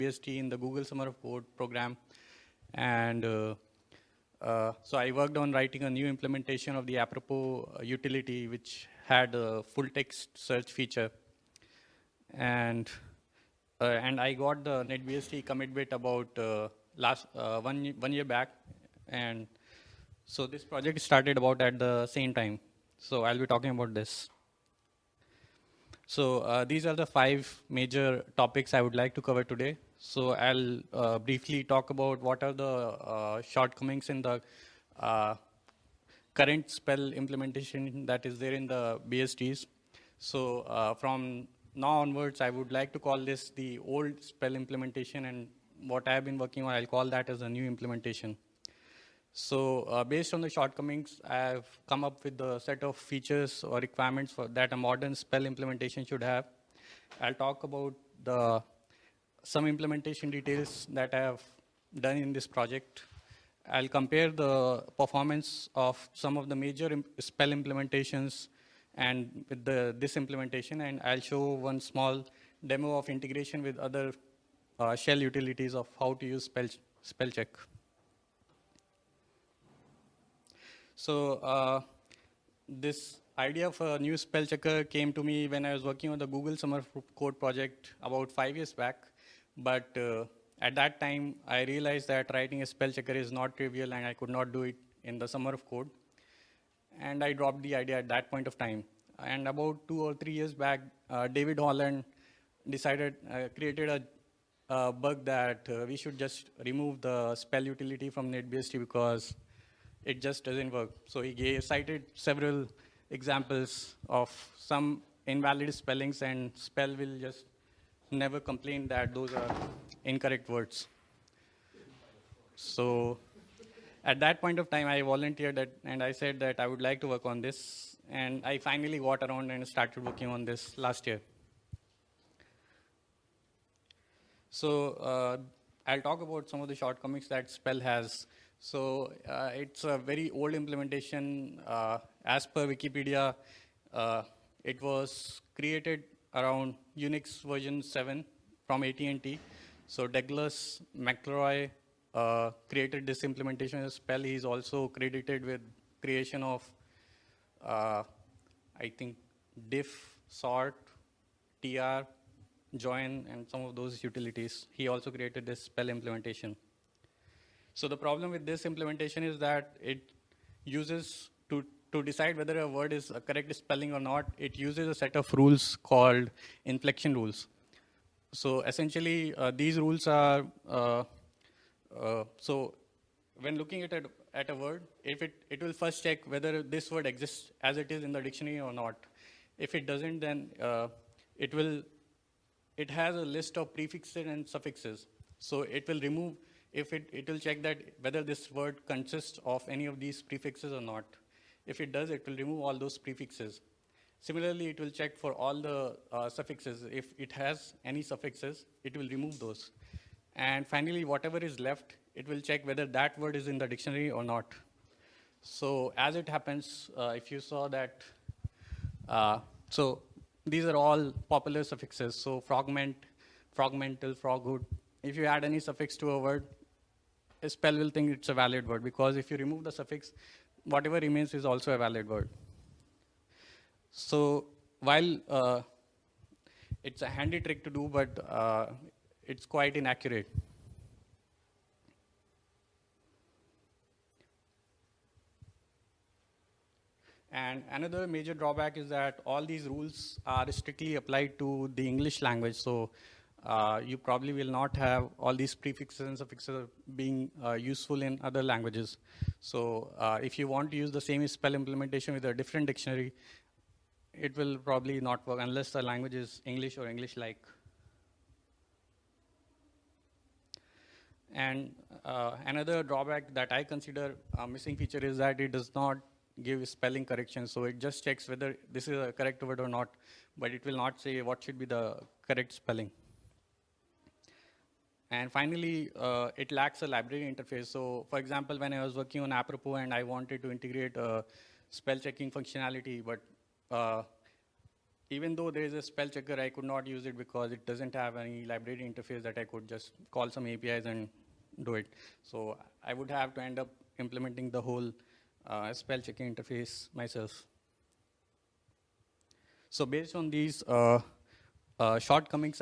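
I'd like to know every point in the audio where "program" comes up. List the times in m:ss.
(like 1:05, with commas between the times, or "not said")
0:01.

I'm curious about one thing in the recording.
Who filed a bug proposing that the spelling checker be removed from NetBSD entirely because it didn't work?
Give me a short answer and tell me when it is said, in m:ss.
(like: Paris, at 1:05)
David Holland, at 1:41.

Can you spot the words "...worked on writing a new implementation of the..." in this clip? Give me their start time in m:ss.
0:05.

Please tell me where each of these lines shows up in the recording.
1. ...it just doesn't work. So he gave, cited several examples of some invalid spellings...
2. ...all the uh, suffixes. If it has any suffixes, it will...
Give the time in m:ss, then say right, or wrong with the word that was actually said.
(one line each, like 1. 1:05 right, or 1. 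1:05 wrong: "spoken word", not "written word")
1. 1:50 right
2. 3:25 right.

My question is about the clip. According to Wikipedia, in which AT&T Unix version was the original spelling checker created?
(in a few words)
Unix version 7.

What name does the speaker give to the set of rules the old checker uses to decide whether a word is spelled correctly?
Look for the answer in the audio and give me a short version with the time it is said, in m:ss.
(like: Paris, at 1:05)
inflection rules, at 2:56.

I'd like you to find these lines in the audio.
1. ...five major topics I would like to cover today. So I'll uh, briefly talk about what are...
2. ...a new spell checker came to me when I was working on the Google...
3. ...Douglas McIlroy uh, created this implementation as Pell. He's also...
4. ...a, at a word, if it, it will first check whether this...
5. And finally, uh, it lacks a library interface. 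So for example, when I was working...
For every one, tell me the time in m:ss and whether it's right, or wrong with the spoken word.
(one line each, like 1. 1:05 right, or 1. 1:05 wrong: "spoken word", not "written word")
1. 0:27 right
2. 1:23 right
3. 2:30 right
4. 3:03 right
5. 4:45 right.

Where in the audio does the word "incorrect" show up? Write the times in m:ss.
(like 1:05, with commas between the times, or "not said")
2:00.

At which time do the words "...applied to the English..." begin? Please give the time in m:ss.
4:10.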